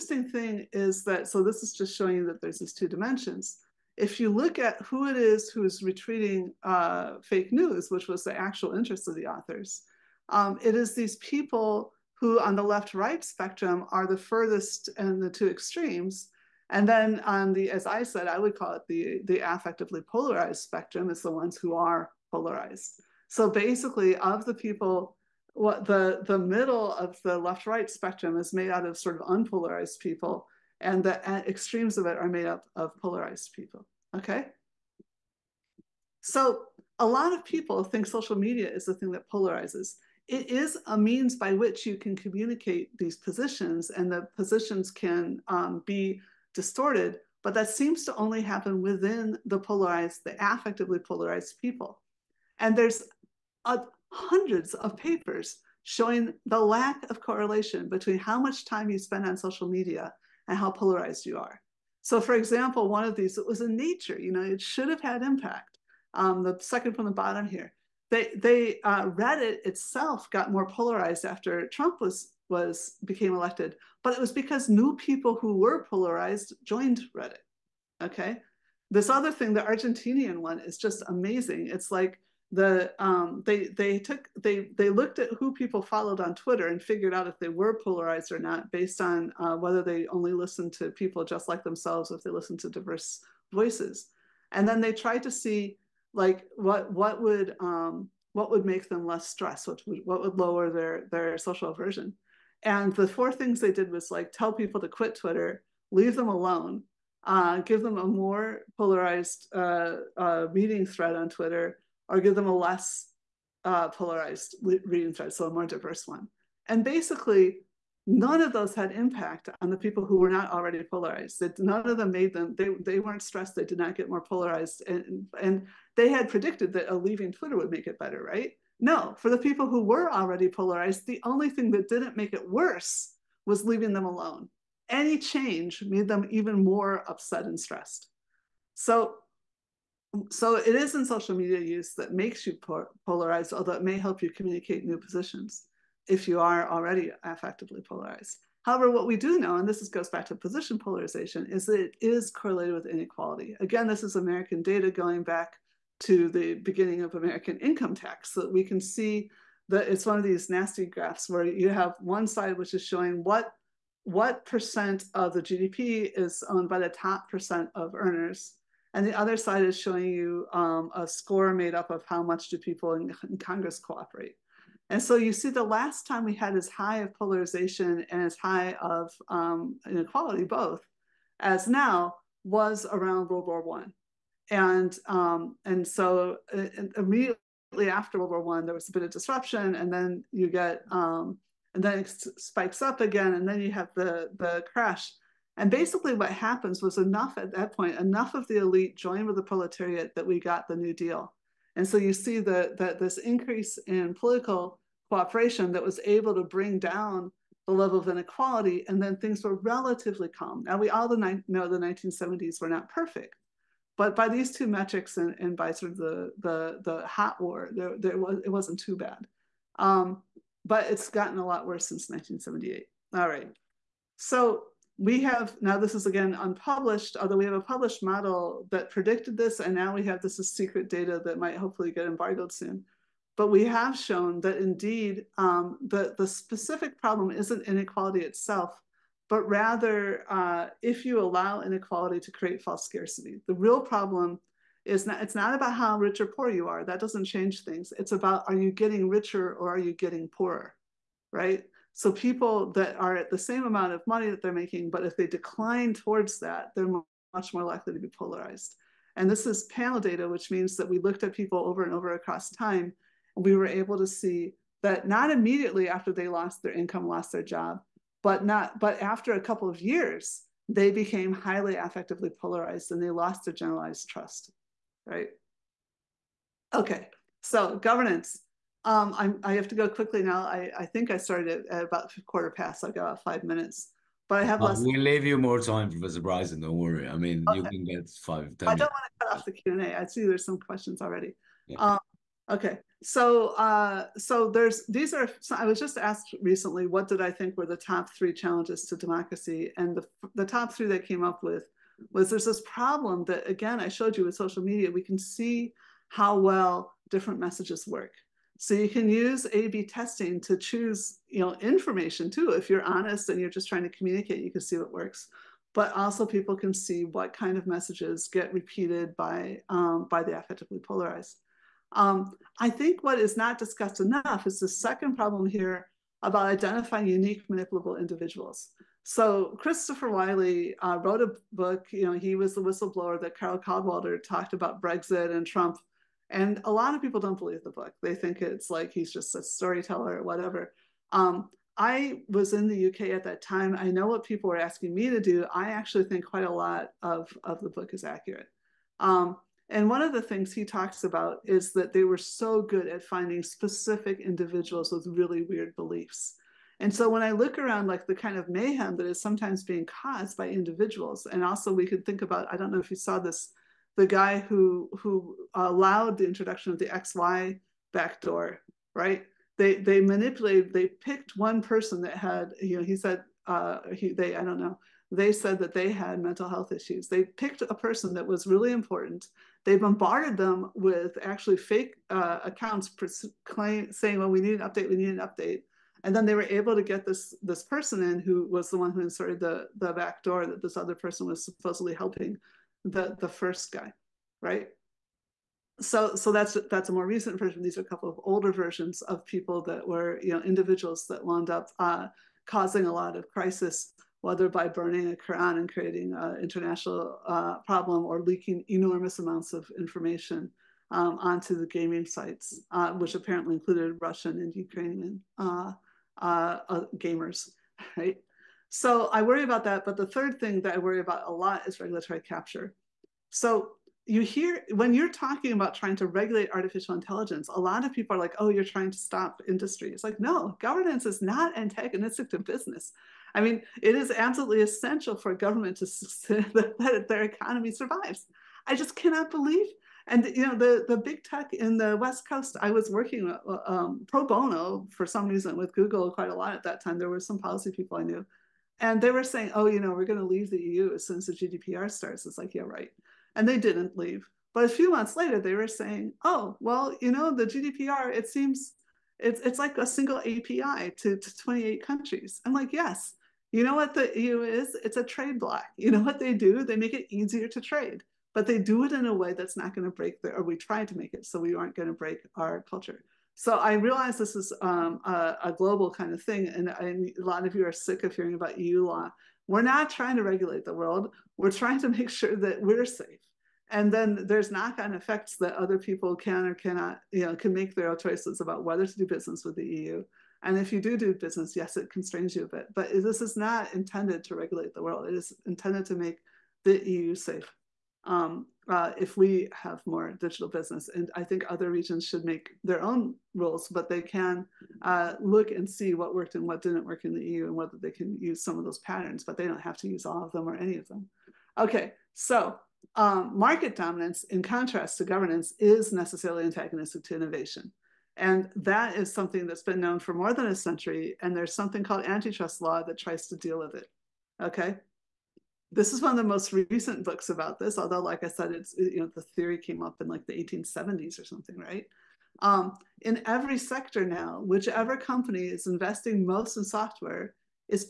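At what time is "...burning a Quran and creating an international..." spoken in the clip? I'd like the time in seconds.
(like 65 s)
404 s.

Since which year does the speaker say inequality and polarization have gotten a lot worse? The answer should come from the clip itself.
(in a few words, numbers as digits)
1978.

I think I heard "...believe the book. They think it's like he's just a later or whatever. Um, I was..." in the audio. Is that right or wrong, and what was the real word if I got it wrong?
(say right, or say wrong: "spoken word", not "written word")
wrong: "storyteller", not "later".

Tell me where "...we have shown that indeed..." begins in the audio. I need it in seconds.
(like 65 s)
233 s.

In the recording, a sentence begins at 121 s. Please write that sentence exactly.
none of them made them, they, they weren't stressed, they did not get more polarized.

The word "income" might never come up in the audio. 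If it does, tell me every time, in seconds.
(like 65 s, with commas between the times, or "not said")
157 s, 266 s.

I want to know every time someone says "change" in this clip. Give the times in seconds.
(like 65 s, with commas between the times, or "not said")
135 s, 247 s.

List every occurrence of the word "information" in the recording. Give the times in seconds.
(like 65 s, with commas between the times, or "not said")
311 s, 409 s.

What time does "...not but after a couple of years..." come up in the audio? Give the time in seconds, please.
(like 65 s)
268 s.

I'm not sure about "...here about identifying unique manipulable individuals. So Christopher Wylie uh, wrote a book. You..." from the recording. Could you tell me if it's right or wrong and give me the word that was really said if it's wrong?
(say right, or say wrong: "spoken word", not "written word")
right.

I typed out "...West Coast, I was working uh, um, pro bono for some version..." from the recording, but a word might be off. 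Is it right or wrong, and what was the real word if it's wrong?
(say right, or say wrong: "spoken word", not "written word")
wrong: "reason", not "version".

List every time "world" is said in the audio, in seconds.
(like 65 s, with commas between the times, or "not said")
183 s, 188 s, 480 s, 494 s.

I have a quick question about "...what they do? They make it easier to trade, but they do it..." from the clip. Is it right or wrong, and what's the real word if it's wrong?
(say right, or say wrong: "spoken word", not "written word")
right.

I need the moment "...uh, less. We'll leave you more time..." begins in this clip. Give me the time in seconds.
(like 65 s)
284 s.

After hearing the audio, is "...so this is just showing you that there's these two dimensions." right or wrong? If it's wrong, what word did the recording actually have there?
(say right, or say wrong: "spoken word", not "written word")
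right.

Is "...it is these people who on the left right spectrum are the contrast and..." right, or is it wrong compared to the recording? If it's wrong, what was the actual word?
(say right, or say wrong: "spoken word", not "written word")
wrong: "furthest", not "contrast".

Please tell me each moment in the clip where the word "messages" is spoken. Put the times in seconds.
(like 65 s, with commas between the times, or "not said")
307 s, 317 s.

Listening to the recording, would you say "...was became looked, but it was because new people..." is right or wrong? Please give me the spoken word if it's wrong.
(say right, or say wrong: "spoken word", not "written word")
wrong: "elected", not "looked".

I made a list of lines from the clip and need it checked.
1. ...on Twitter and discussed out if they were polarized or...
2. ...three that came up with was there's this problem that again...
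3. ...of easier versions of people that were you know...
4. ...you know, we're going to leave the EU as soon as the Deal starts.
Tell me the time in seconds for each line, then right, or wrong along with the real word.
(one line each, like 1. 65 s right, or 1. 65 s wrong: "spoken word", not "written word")
1. 86 s wrong: "figured", not "discussed"
2. 300 s right
3. 398 s wrong: "older", not "easier"
4. 449 s wrong: "GDPR", not "Deal".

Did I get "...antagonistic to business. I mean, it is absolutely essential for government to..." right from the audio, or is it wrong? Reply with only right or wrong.
right.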